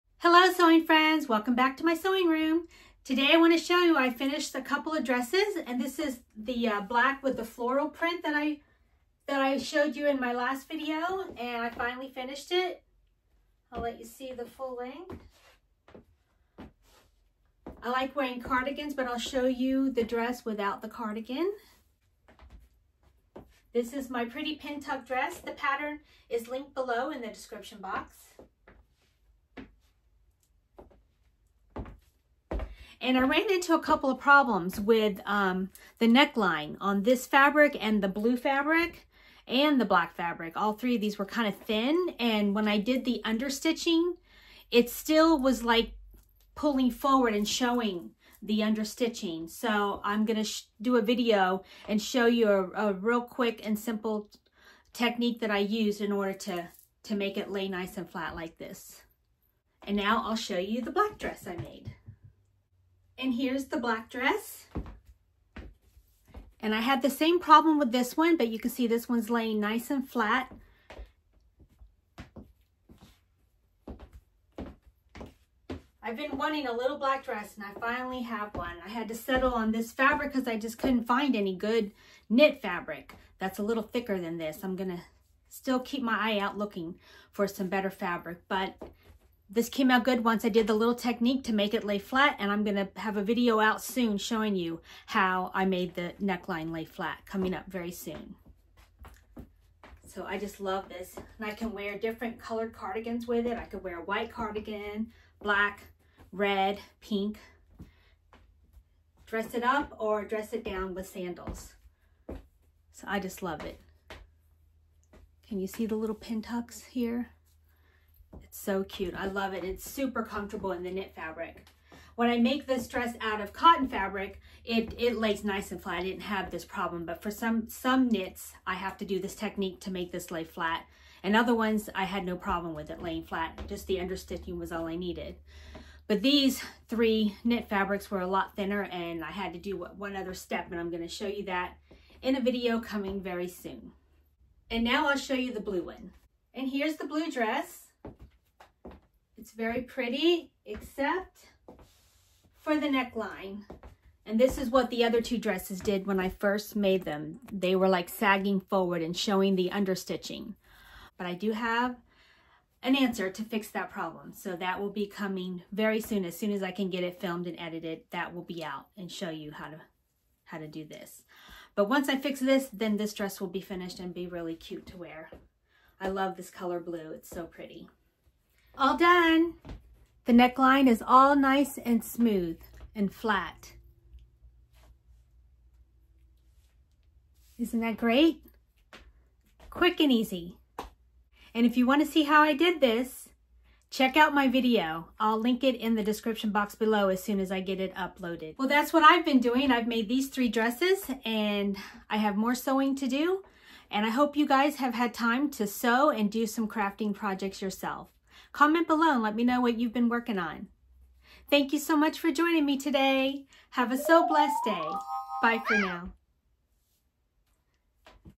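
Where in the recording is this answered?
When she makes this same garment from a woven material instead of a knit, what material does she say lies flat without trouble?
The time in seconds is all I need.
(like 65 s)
123 s.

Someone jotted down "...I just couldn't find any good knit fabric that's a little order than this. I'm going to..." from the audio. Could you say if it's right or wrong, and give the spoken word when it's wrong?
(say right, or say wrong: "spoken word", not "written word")
wrong: "thicker", not "order".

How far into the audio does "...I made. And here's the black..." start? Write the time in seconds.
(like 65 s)
61 s.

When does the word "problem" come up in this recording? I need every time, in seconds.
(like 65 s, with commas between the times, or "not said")
34 s, 67 s, 126 s, 132 s, 163 s.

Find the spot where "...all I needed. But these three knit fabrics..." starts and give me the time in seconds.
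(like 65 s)
134 s.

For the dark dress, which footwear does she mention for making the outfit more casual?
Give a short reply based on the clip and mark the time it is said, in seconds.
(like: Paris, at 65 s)
Sandals, at 111 s.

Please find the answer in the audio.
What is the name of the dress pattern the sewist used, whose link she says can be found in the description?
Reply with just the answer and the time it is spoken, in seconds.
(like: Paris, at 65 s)
Pretty pin tuck dress, at 24 s.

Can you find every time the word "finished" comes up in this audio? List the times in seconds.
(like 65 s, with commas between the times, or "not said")
4 s, 12 s, 173 s.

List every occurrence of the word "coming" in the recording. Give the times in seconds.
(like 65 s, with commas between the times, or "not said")
97 s, 142 s, 165 s.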